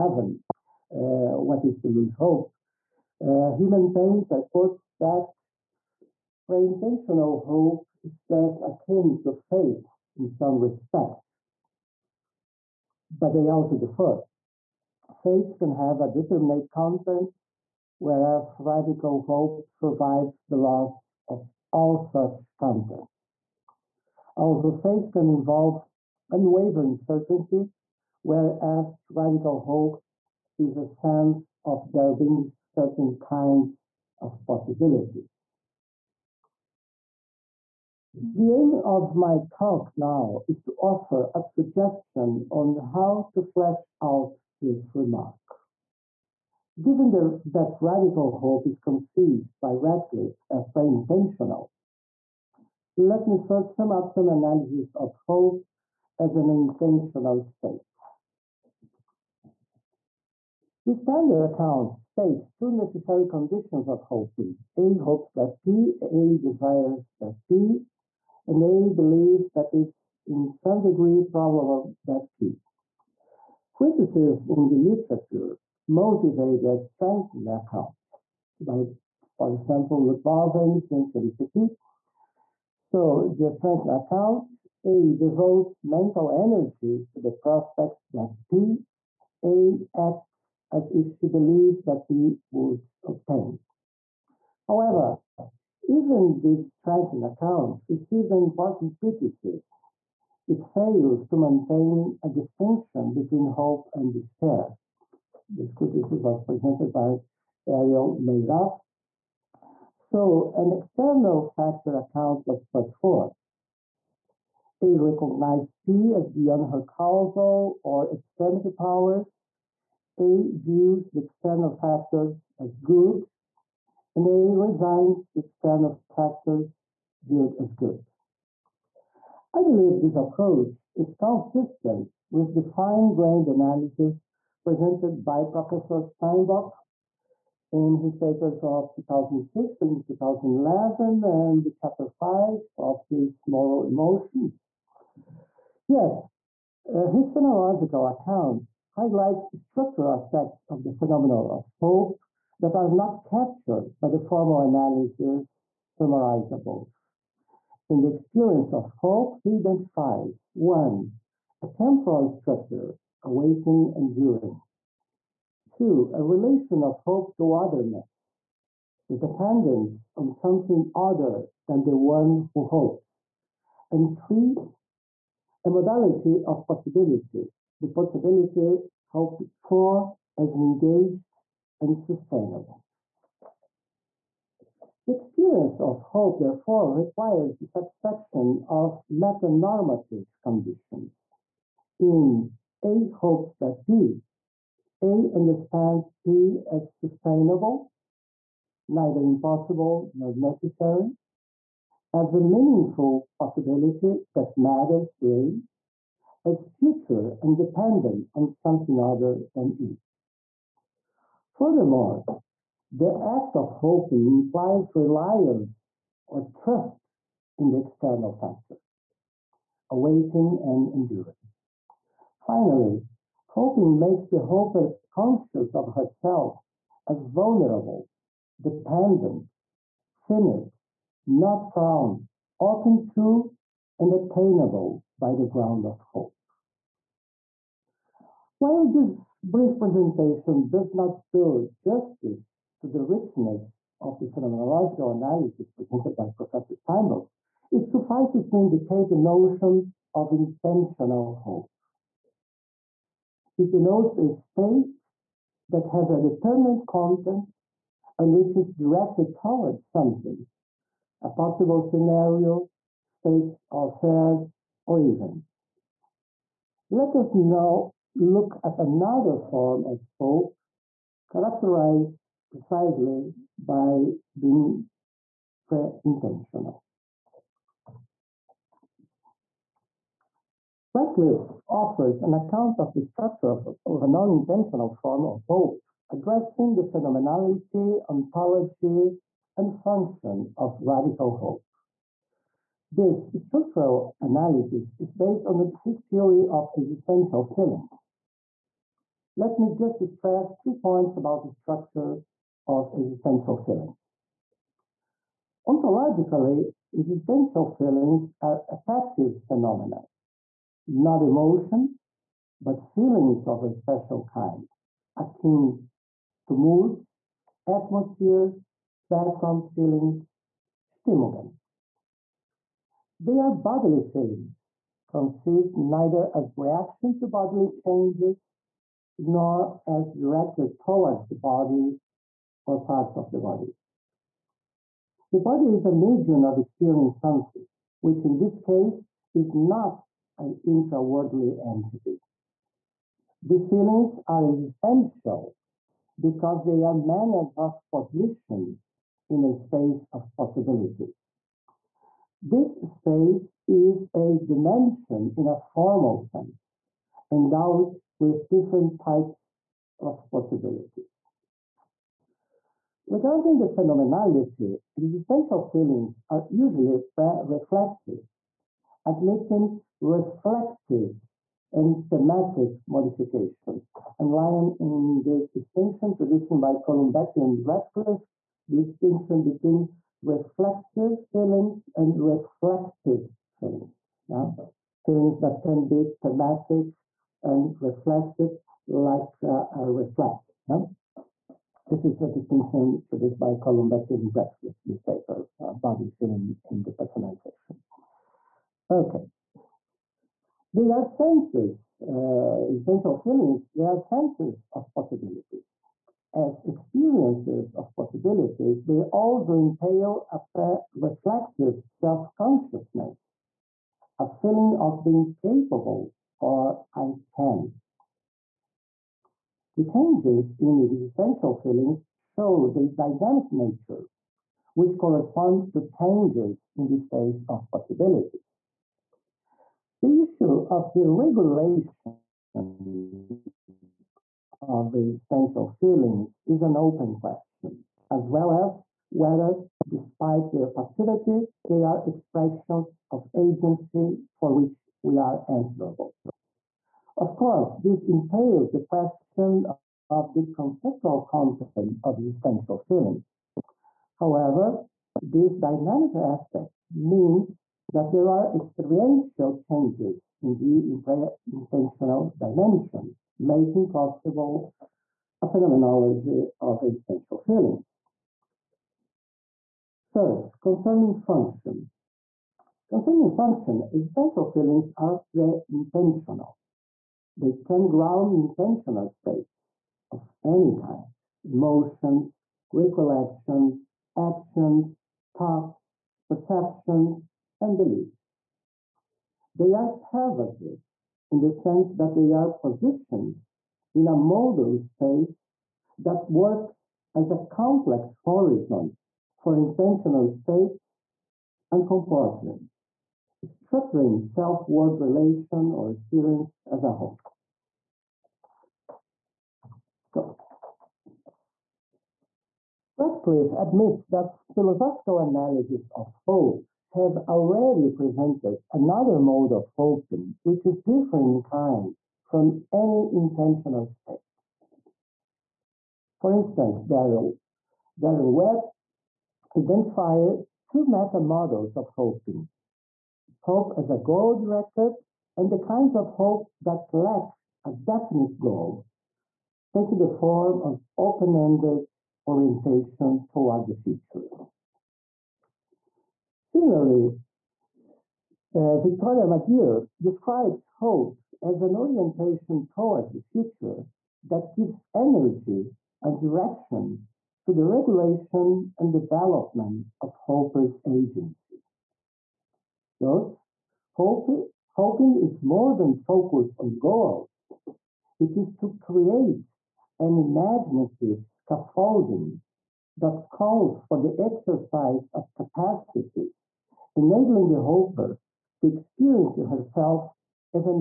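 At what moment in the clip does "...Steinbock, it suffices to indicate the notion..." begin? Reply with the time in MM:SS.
04:06.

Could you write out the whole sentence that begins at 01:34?
However, even this strengthened account received an important criticism.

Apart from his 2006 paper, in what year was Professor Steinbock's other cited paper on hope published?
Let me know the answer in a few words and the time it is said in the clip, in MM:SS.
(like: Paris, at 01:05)
2011, at 02:20.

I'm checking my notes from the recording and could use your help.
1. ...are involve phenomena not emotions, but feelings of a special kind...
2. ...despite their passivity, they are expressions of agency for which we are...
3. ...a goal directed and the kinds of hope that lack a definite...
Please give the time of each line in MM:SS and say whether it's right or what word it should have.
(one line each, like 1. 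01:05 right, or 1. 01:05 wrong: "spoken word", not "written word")
1. 05:08 wrong: "affective", not "involve"
2. 07:19 right
3. 08:53 right.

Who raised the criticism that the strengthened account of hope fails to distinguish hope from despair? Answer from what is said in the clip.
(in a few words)
Ariel Meirav.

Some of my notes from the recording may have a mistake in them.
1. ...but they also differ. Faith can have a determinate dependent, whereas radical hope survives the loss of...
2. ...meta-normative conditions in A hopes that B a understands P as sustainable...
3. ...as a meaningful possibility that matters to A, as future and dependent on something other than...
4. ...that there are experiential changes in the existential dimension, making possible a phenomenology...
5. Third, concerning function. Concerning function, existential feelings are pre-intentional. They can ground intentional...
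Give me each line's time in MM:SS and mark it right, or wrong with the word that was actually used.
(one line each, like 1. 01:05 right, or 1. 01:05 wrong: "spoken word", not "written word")
1. 00:13 wrong: "content", not "dependent"
2. 03:09 right
3. 03:22 right
4. 07:37 wrong: "intentional", not "existential"
5. 07:50 right.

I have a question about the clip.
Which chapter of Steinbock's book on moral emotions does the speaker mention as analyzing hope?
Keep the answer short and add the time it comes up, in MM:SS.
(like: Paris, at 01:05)
Chapter 5, at 02:21.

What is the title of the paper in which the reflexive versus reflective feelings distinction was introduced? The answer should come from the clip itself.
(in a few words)
Body Feeling in Depersonalization.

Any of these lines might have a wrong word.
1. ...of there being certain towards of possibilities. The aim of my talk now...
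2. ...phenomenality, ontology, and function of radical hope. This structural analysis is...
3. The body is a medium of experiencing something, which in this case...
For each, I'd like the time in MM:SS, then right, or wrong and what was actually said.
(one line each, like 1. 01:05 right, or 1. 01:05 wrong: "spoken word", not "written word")
1. 00:31 wrong: "kinds", not "towards"
2. 04:46 right
3. 05:35 right.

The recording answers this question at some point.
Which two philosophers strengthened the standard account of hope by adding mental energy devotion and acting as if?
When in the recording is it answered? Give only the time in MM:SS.
01:20.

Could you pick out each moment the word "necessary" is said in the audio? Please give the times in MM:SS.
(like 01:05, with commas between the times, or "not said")
01:02, 03:20.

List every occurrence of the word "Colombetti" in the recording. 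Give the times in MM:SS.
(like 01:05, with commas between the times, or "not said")
06:16, 06:33.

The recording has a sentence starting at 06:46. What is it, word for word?
As experiences of possibilities, they also entail a pre- reflexive self consciousness, a feeling of being capable or I can.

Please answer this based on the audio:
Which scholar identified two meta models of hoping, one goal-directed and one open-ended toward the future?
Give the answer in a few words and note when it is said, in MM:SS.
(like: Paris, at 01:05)
Darren Webb, at 08:47.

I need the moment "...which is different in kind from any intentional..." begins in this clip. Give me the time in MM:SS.
08:40.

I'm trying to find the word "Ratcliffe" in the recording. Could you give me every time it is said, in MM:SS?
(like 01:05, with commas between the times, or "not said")
00:49, 04:40, 06:17, 06:34, 08:33.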